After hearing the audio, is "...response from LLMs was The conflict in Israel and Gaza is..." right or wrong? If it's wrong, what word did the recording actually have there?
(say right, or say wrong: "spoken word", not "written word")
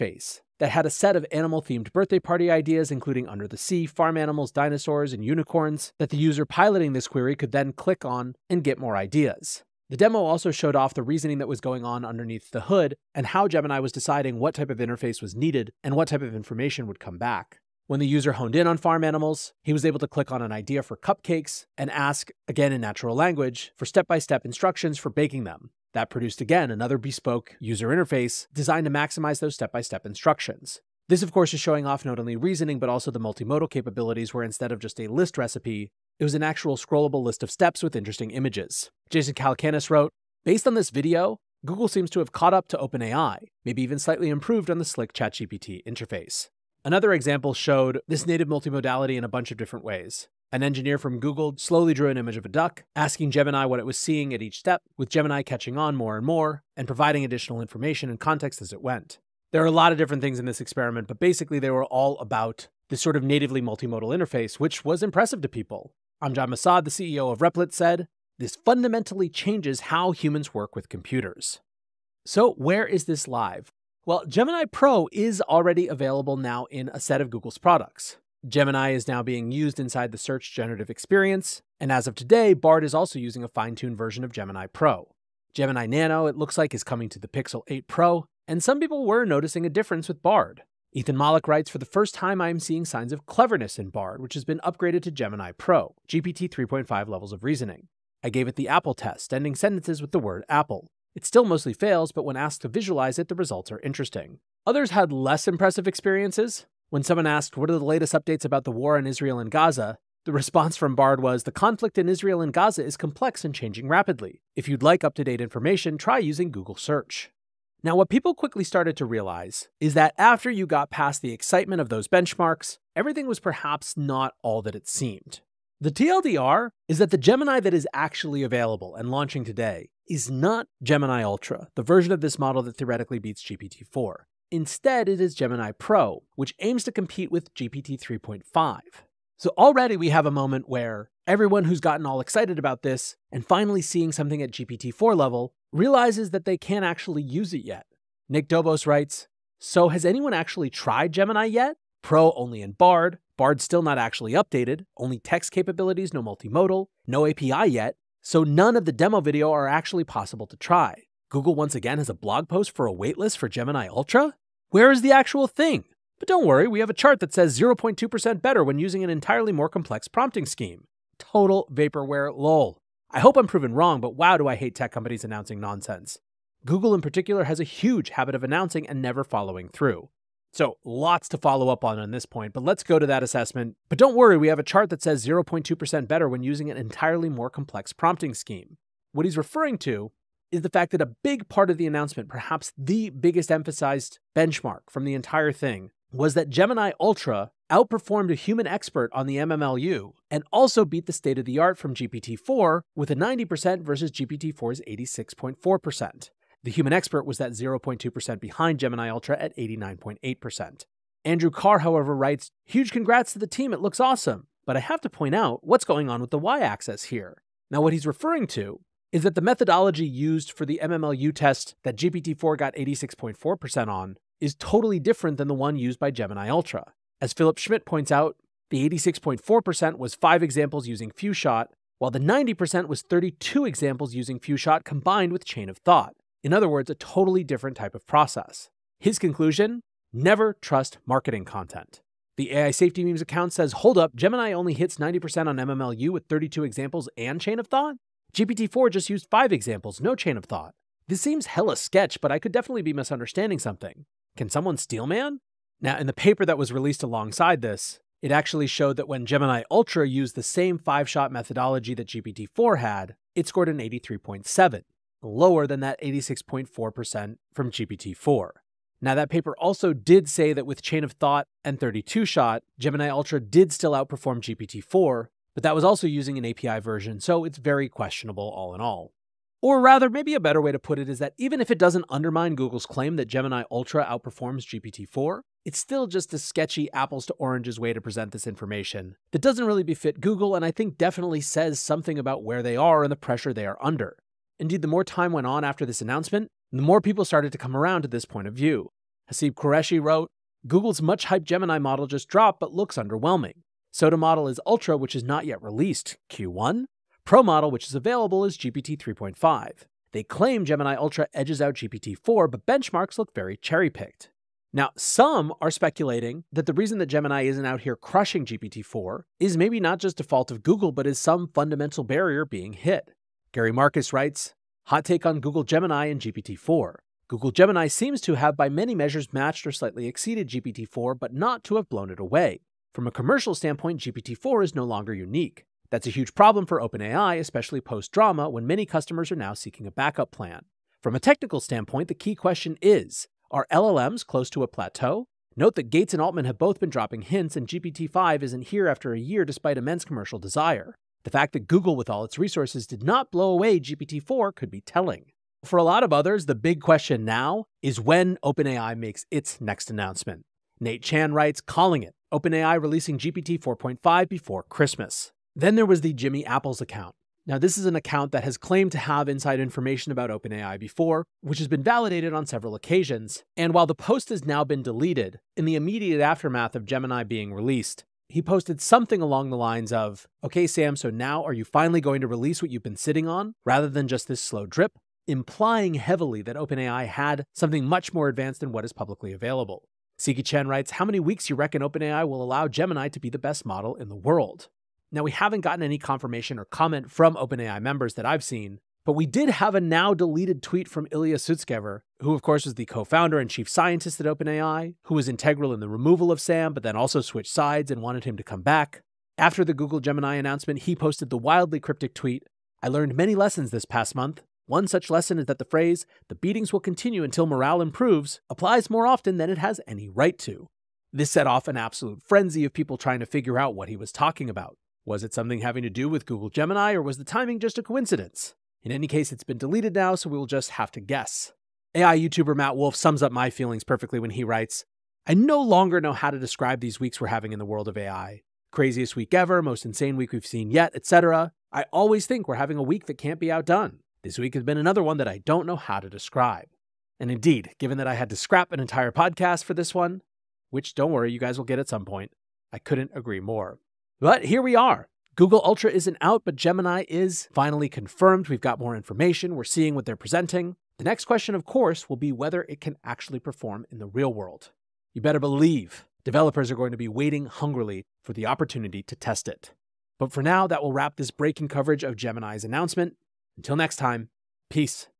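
wrong: "Bard", not "LLMs".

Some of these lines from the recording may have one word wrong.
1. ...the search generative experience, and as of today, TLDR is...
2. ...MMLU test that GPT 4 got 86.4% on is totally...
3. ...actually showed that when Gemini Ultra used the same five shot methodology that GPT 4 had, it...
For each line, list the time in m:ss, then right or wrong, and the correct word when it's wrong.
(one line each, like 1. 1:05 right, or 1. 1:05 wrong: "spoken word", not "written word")
1. 1:20 wrong: "Bard", not "TLDR"
2. 3:40 right
3. 4:18 right.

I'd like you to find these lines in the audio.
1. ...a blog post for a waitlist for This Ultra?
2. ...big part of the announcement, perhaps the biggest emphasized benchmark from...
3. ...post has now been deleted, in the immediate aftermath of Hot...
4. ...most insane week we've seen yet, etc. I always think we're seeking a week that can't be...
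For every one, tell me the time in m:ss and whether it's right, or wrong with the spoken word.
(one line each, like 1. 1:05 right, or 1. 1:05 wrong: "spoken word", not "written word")
1. 2:42 wrong: "Gemini", not "This"
2. 3:11 right
3. 6:13 wrong: "Gemini", not "Hot"
4. 7:19 wrong: "having", not "seeking".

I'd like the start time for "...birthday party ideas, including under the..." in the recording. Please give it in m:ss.
0:01.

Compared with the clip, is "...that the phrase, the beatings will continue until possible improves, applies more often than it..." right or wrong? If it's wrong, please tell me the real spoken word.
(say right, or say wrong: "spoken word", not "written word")
wrong: "morale", not "possible".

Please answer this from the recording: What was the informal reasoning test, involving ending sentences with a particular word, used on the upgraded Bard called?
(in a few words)
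The Apple test.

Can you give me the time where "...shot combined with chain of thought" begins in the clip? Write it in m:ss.
3:54.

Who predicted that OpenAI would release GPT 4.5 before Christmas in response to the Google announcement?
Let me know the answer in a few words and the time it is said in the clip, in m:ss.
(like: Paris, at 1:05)
Nate Chan, at 6:00.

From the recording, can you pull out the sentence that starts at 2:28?
Nick Dobos writes So, has anyone actually tried Gemini yet?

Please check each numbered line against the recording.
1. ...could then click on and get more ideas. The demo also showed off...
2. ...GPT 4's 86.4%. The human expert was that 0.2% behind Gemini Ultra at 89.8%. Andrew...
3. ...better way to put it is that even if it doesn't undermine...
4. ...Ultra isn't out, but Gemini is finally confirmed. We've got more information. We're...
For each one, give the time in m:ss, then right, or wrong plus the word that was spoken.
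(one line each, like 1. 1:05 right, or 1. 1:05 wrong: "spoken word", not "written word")
1. 0:07 right
2. 3:24 right
3. 4:40 right
4. 7:35 right.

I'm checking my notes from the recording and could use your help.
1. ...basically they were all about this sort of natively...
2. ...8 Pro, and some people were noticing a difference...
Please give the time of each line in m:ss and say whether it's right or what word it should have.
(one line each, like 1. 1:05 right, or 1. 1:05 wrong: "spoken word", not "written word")
1. 1:01 right
2. 1:27 right.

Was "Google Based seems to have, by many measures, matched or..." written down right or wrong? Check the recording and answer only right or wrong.
wrong.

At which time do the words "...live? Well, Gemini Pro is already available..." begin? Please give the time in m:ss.
1:13.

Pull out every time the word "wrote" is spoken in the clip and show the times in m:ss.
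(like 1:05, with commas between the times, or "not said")
0:39, 4:59.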